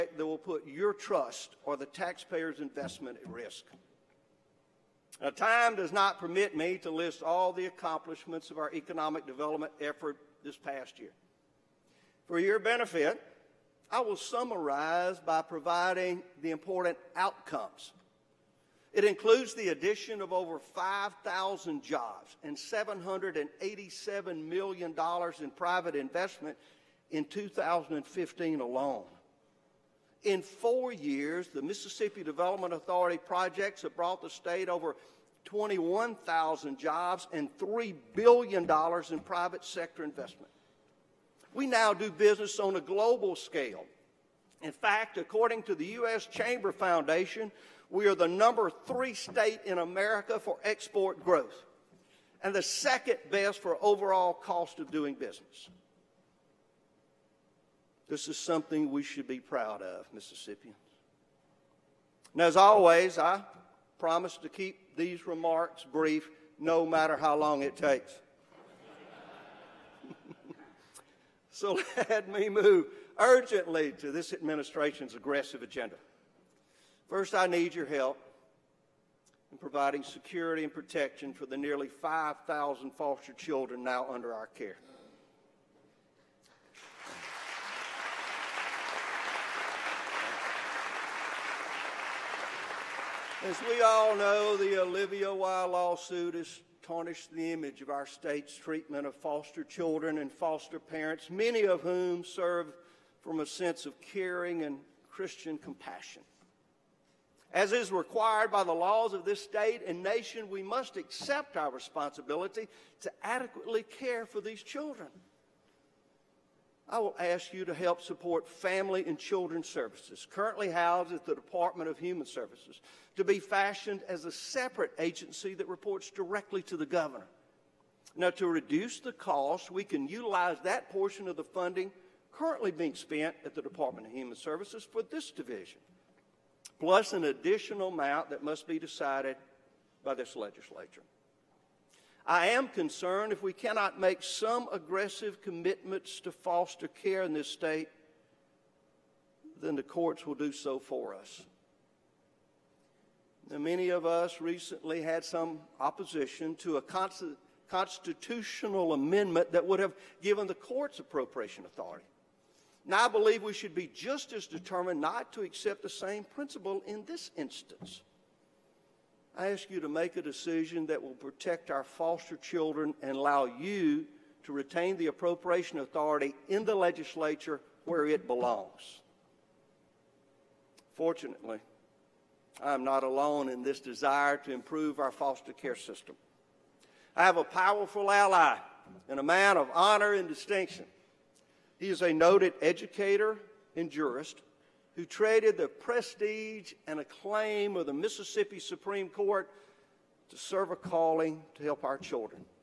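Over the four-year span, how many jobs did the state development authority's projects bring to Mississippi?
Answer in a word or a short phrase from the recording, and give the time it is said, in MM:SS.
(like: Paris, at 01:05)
over 21,000, at 00:34.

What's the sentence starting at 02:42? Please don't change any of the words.
Now, I believe we should be just as determined not to accept the same principle in this instance.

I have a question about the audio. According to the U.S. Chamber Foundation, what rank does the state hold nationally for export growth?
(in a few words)
number three.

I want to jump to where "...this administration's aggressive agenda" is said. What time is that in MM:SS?
01:14.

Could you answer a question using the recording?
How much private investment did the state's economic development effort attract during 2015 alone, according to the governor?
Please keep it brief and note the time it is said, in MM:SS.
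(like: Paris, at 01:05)
$787 million, at 00:22.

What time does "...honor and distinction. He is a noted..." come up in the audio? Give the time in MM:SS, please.
03:09.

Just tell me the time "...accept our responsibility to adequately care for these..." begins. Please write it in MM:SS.
01:50.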